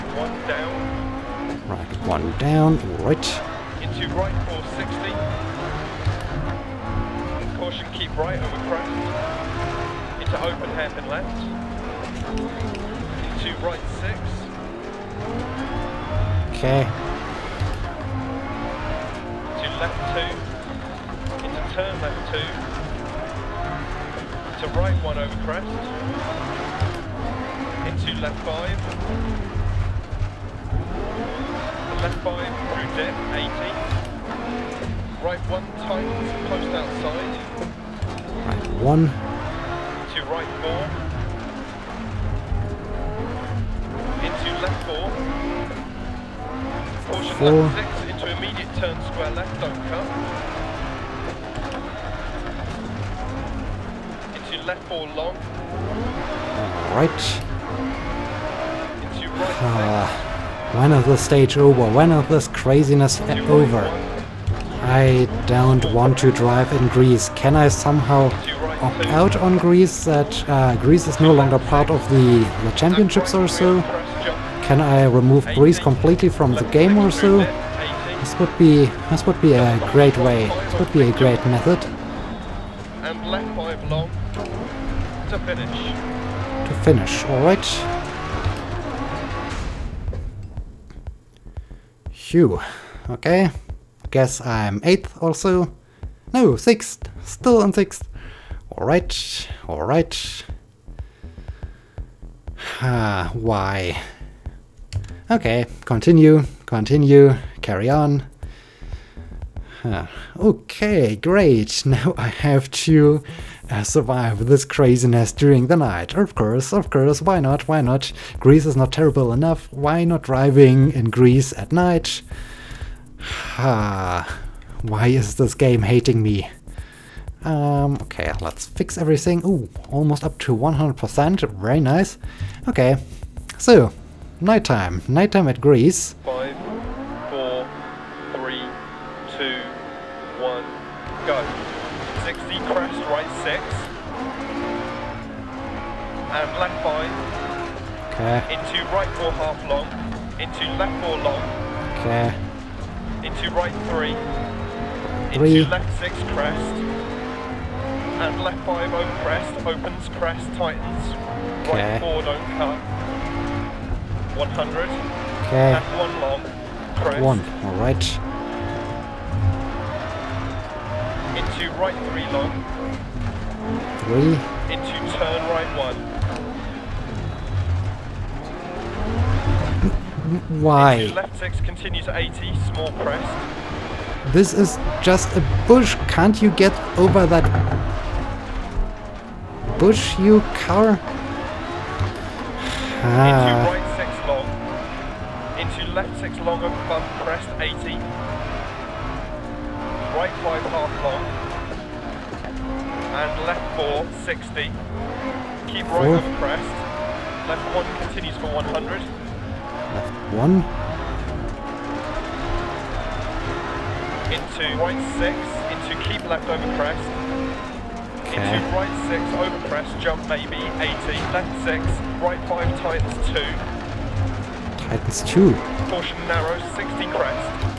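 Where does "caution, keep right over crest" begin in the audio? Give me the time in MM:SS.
00:07.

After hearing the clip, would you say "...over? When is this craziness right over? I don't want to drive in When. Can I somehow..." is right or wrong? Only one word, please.
wrong.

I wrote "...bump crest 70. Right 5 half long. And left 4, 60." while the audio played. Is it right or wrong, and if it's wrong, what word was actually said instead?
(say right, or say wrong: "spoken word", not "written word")
wrong: "80", not "70".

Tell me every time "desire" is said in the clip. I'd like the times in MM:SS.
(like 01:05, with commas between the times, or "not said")
not said.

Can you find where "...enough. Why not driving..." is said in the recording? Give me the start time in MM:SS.
01:59.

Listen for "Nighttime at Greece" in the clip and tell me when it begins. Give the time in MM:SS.
02:15.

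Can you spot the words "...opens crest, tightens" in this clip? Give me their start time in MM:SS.
02:39.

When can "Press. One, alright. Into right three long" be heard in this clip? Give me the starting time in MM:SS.
02:46.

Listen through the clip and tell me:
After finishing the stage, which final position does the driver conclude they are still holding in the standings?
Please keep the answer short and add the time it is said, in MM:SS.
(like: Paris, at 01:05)
6th, at 01:37.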